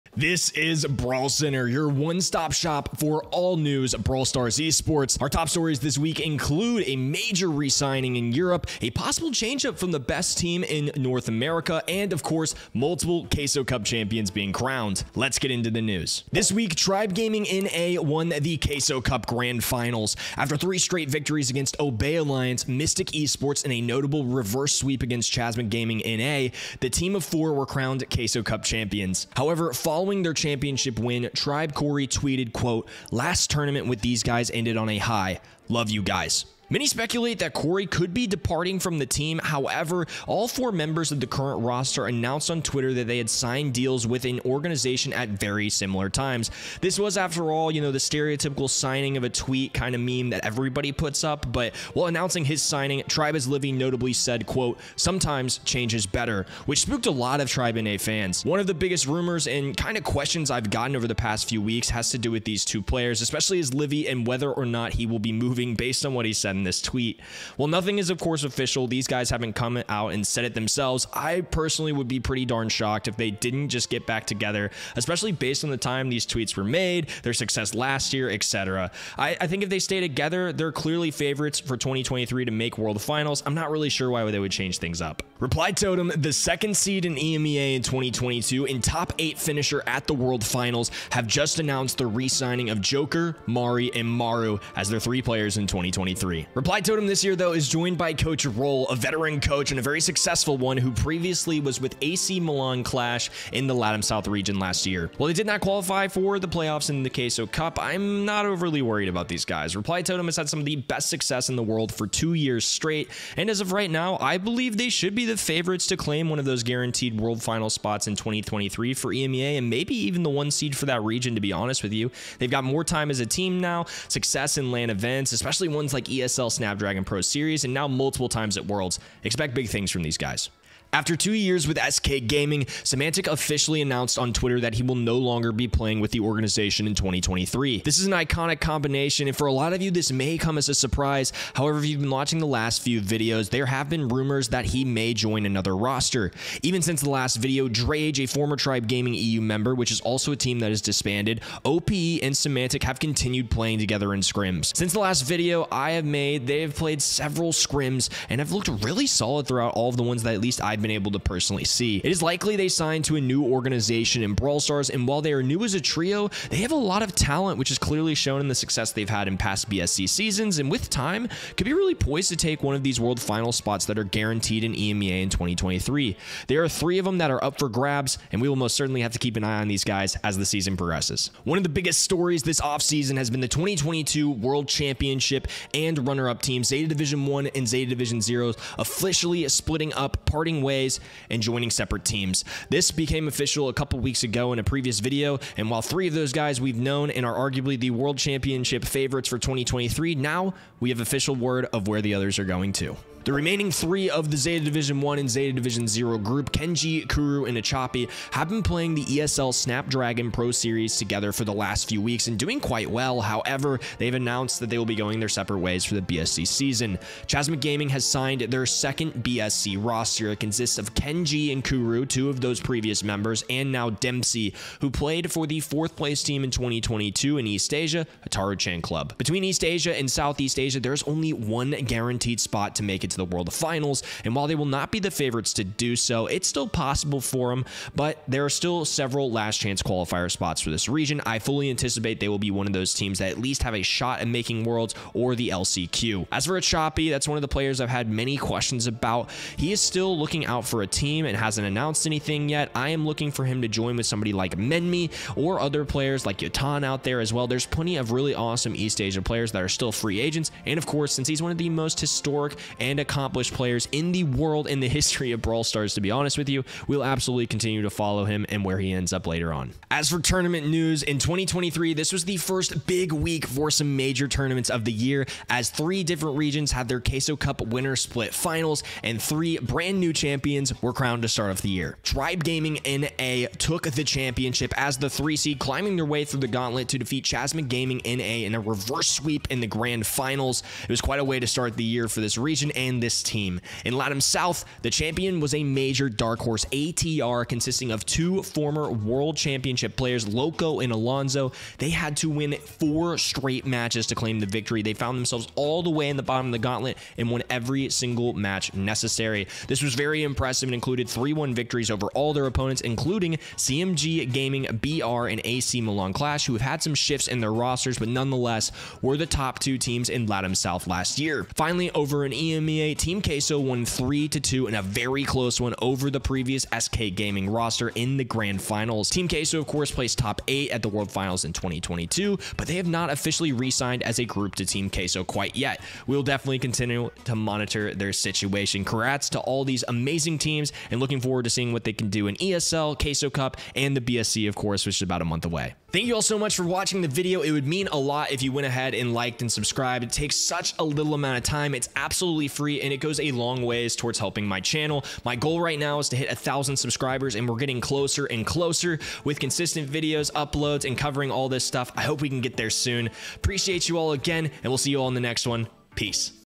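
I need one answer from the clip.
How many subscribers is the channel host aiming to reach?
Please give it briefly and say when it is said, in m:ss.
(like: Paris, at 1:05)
1000, at 5:56.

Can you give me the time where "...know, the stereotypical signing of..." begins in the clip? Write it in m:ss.
0:47.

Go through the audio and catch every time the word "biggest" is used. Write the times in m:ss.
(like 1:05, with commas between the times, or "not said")
0:58, 3:01.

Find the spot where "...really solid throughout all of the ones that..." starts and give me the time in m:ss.
2:38.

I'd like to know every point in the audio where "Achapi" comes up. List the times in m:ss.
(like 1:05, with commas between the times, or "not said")
3:27, 4:06.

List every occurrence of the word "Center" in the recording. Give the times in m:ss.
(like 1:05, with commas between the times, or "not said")
0:01.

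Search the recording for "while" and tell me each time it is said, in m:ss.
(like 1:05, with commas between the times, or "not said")
0:51, 1:45, 2:45, 3:15, 3:54.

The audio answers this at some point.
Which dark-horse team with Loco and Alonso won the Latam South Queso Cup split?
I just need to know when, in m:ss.
4:56.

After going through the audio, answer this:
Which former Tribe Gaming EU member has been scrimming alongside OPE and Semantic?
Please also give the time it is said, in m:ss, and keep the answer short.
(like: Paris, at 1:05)
Drage, at 2:27.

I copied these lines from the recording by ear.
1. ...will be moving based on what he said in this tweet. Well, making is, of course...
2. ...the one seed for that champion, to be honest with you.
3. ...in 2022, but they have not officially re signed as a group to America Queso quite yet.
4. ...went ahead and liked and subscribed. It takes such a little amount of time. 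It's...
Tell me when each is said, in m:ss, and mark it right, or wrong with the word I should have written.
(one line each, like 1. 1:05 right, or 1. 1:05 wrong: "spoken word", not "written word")
1. 1:05 wrong: "nothing", not "making"
2. 2:00 wrong: "region", not "champion"
3. 5:31 wrong: "Team", not "America"
4. 5:48 right.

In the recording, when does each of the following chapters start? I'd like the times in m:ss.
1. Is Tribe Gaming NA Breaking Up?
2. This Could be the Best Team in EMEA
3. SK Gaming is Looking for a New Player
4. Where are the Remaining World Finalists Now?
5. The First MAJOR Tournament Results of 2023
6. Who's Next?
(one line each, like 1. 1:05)
1. 0:16
2. 1:25
3. 2:10
4. 3:01
5. 4:29
6. 5:45.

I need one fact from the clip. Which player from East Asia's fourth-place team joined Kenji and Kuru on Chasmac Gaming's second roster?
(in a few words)
Dempsey.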